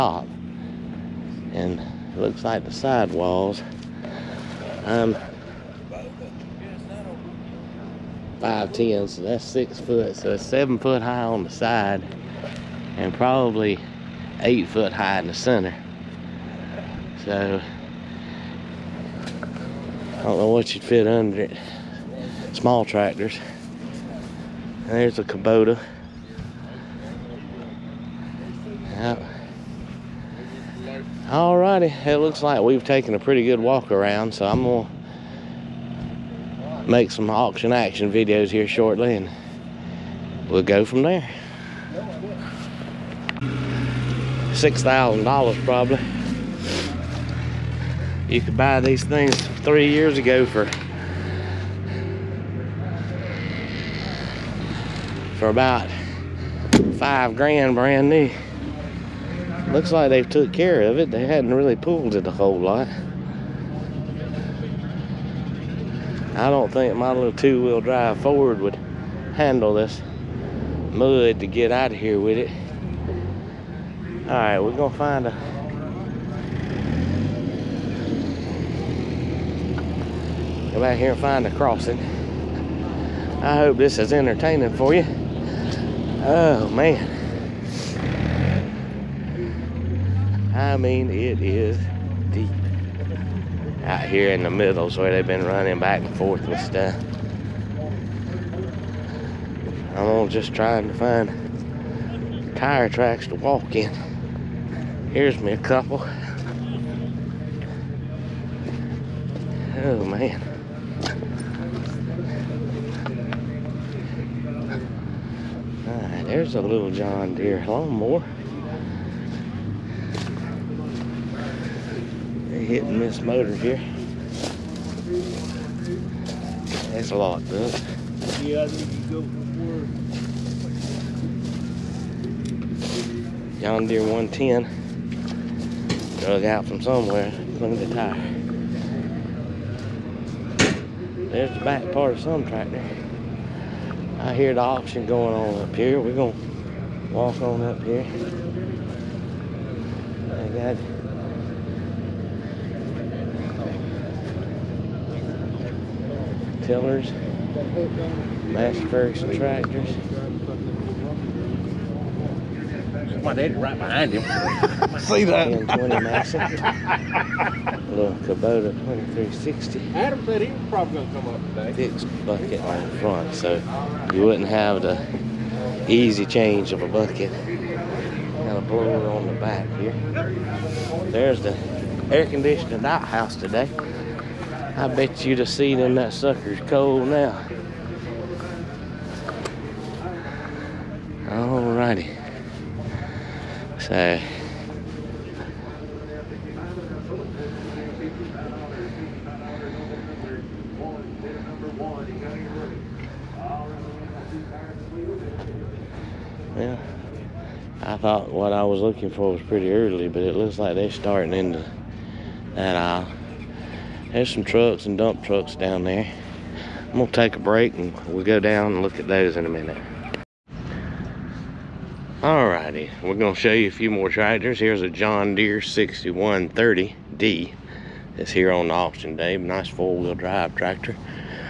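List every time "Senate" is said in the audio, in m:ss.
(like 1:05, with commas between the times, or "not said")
not said.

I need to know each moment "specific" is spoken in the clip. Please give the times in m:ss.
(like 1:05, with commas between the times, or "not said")
not said.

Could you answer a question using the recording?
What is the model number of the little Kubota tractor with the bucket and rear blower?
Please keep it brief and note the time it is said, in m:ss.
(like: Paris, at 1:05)
2360, at 2:48.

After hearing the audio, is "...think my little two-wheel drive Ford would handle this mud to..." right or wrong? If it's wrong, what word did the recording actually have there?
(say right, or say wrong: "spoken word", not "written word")
right.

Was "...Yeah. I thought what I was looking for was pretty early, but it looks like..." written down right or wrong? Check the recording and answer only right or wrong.
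right.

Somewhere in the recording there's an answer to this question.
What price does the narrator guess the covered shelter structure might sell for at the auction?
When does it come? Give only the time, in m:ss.
0:44.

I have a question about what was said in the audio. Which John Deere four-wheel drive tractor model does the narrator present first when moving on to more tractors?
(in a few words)
John Deere 6130D.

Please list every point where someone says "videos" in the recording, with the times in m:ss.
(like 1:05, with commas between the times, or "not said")
0:38.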